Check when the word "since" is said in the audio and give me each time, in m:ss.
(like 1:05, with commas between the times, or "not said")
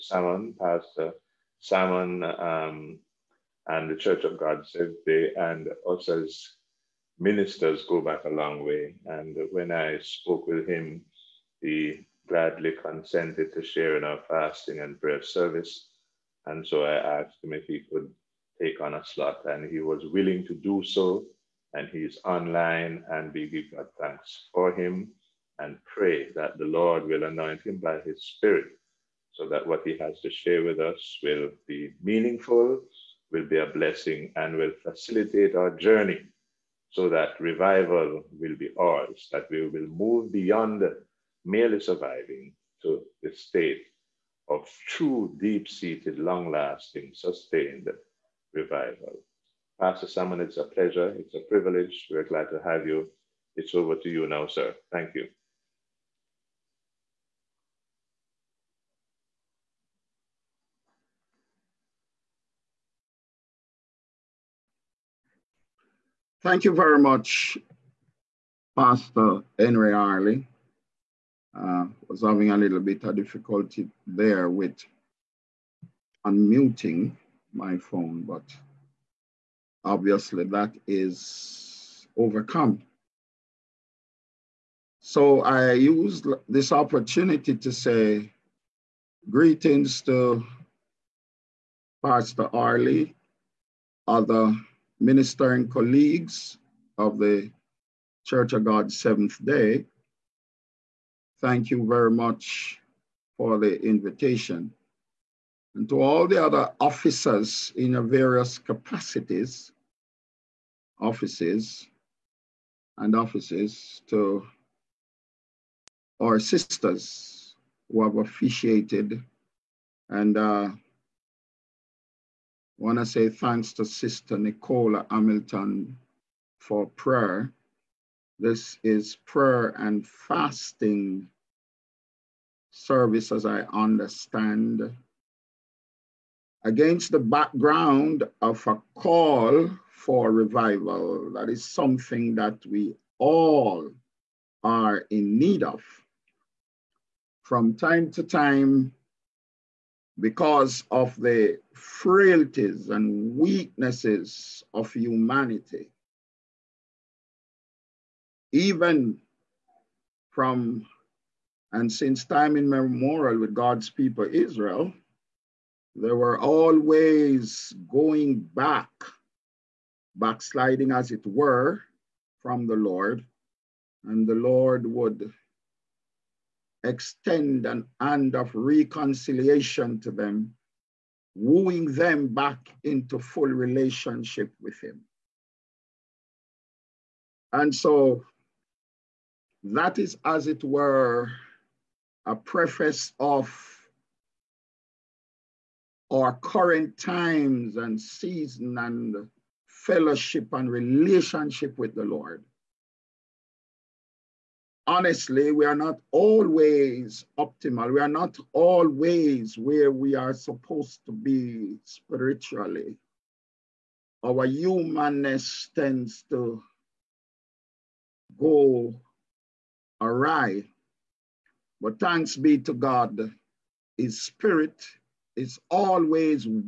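2:41.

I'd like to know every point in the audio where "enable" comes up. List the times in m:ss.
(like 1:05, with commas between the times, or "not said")
not said.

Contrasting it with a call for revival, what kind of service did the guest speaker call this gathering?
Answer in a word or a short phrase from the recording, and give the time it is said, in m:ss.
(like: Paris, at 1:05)
prayer and fasting, at 2:09.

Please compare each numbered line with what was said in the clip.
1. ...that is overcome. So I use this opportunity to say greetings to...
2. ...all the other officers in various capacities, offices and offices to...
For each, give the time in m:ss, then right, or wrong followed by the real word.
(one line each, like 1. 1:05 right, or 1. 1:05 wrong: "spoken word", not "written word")
1. 1:20 right
2. 1:46 right.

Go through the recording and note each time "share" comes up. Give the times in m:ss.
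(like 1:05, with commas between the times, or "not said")
0:13, 0:30.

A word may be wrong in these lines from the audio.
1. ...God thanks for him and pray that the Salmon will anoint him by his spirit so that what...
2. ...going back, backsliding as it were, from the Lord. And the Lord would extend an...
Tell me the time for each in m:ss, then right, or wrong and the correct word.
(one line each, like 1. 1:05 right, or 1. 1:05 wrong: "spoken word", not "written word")
1. 0:23 wrong: "Lord", not "Salmon"
2. 2:47 right.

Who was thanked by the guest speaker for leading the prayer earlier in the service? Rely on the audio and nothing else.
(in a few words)
Nicola Hamilton.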